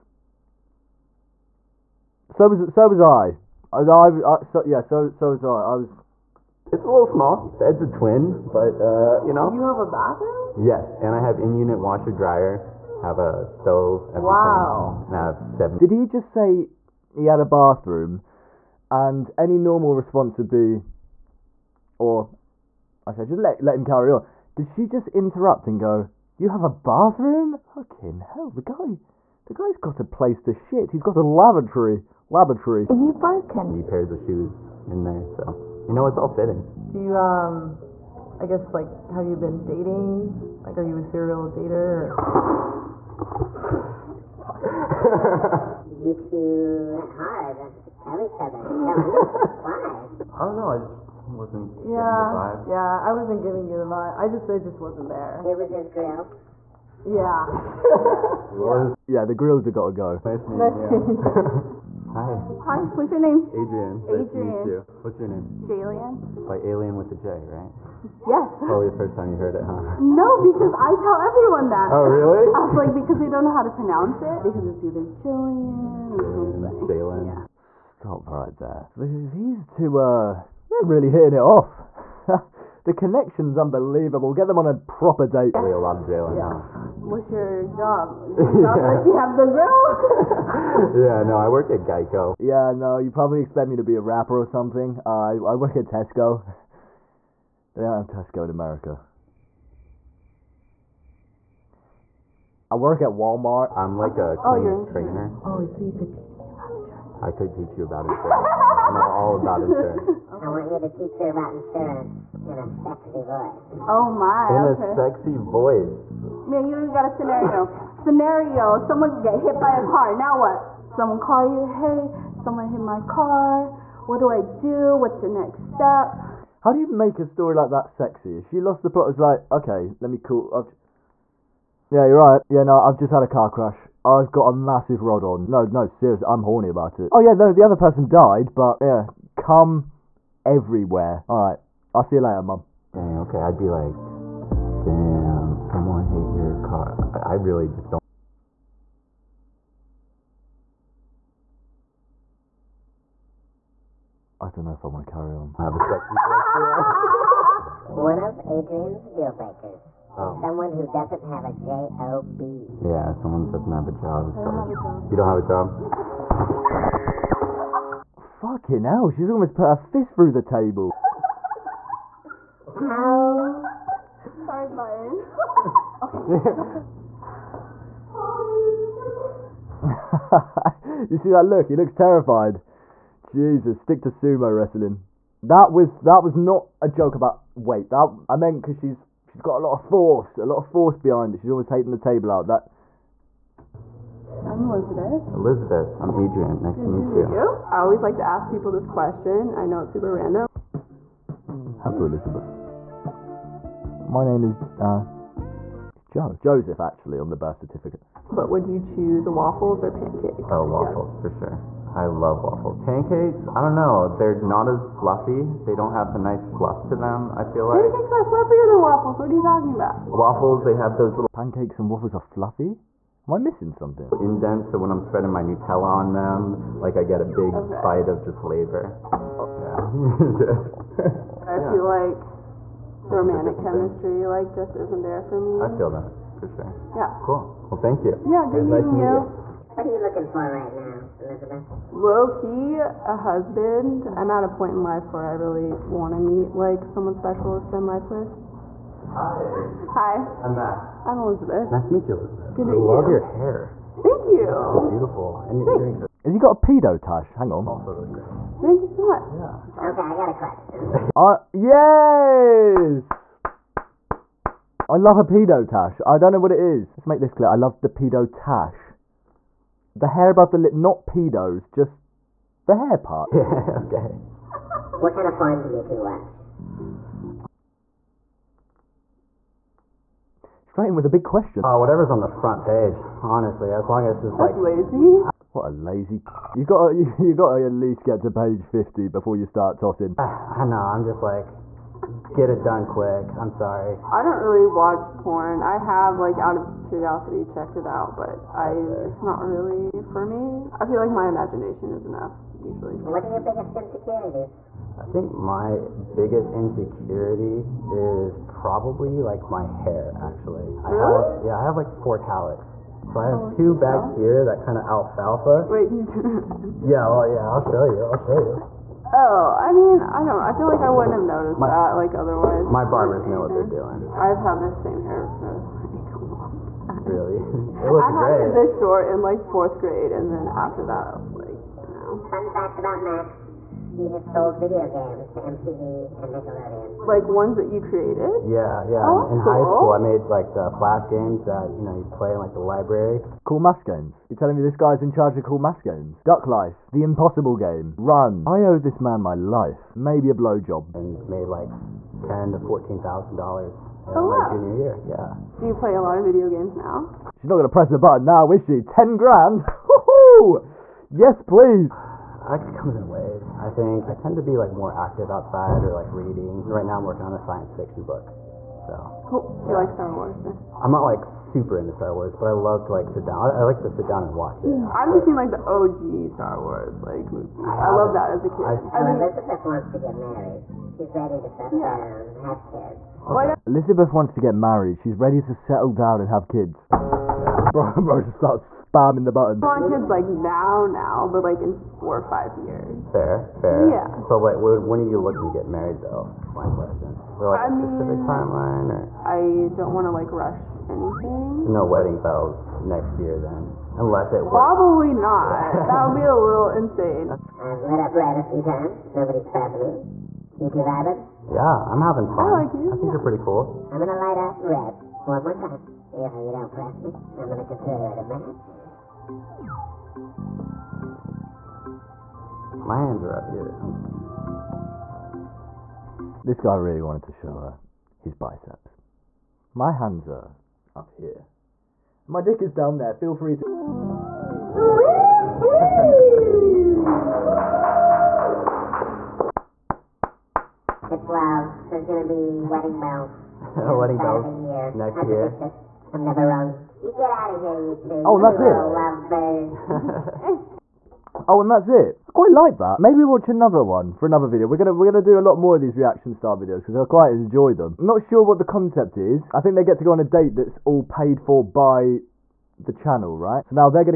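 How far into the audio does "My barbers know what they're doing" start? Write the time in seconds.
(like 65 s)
322 s.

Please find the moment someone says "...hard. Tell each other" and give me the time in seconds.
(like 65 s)
47 s.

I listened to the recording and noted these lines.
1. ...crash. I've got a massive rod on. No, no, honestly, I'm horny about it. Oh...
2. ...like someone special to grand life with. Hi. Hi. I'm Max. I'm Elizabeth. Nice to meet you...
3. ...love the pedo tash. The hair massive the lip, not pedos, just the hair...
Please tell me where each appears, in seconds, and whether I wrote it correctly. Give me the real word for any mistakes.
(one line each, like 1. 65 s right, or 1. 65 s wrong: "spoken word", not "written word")
1. 133 s wrong: "seriously", not "honestly"
2. 246 s wrong: "spend", not "grand"
3. 267 s wrong: "above", not "massive".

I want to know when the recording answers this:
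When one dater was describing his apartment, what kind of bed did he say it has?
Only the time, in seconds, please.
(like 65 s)
7 s.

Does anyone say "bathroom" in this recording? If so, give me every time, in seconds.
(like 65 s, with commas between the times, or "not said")
9 s, 17 s, 26 s.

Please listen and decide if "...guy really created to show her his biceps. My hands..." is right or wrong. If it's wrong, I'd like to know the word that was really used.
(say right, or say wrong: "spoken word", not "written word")
wrong: "wanted", not "created".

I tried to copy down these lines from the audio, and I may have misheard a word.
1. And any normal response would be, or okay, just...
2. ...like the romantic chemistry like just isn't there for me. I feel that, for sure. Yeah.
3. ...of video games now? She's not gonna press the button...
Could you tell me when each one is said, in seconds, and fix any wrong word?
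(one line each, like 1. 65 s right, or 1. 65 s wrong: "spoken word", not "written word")
1. 18 s right
2. 231 s right
3. 356 s right.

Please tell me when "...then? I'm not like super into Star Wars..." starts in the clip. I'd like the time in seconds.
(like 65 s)
370 s.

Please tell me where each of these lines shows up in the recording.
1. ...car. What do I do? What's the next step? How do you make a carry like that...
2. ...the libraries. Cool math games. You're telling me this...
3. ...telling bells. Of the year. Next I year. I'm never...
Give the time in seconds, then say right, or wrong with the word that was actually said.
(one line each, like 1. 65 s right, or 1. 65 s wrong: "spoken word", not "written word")
1. 123 s wrong: "story", not "carry"
2. 342 s right
3. 443 s wrong: "wedding", not "telling".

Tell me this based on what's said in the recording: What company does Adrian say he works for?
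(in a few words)
Geico.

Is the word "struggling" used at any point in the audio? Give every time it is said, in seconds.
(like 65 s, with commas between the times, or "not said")
not said.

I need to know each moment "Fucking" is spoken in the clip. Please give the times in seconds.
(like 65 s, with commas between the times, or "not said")
27 s, 168 s.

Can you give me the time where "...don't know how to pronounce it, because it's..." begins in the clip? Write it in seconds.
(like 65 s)
73 s.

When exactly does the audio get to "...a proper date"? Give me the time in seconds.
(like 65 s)
84 s.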